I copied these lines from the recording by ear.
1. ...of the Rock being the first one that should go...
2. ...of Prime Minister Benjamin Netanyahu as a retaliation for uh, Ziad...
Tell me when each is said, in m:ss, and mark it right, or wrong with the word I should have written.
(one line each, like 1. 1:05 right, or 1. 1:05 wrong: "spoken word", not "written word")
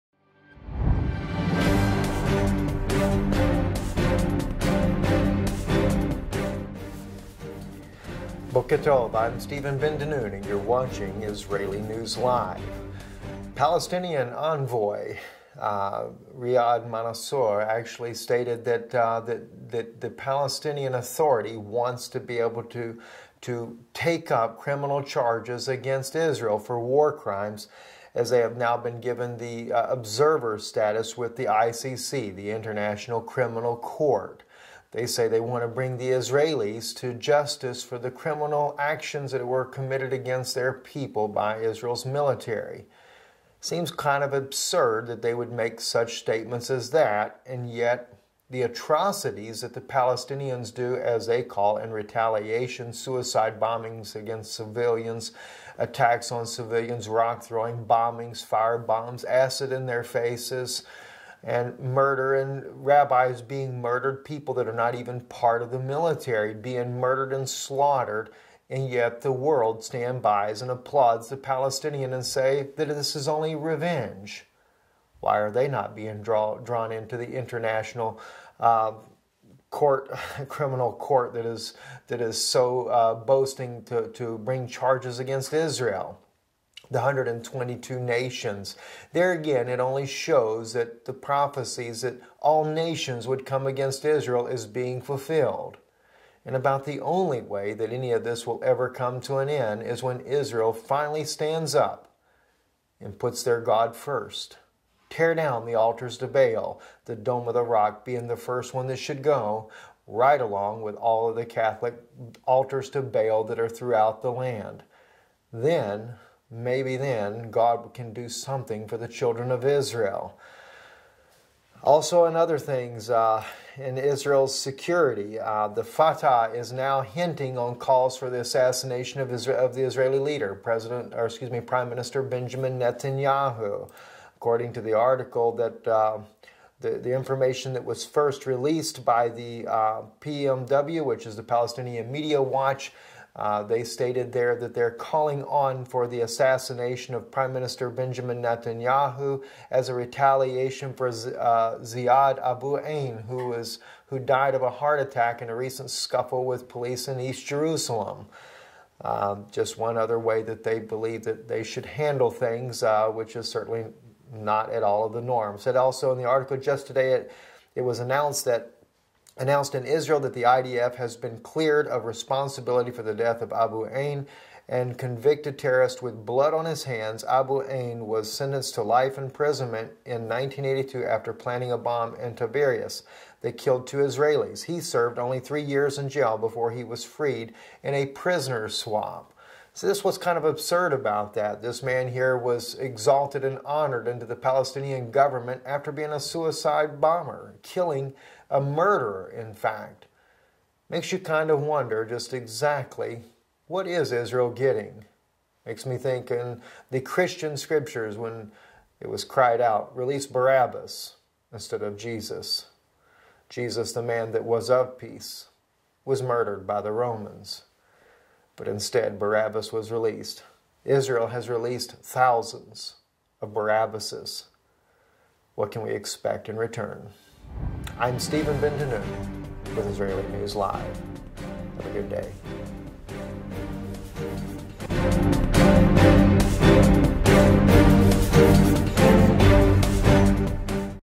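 1. 1:47 right
2. 2:27 right.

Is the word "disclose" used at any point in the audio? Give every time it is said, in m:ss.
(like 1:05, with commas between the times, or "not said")
not said.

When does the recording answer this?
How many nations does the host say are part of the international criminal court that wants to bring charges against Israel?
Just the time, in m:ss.
1:26.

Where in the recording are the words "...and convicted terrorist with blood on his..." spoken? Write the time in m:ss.
2:54.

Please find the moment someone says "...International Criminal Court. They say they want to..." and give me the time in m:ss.
0:32.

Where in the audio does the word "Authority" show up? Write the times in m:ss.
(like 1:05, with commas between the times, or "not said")
0:20.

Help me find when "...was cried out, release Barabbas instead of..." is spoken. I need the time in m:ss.
3:29.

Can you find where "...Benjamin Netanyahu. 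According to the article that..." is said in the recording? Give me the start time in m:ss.
2:12.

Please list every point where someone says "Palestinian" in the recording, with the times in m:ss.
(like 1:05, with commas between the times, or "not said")
0:13, 0:20, 0:49, 1:11, 2:21, 3:14.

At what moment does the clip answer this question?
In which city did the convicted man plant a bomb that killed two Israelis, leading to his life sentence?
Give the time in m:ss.
3:02.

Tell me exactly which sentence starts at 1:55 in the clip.
Then maybe then God can do something for the children of Israel.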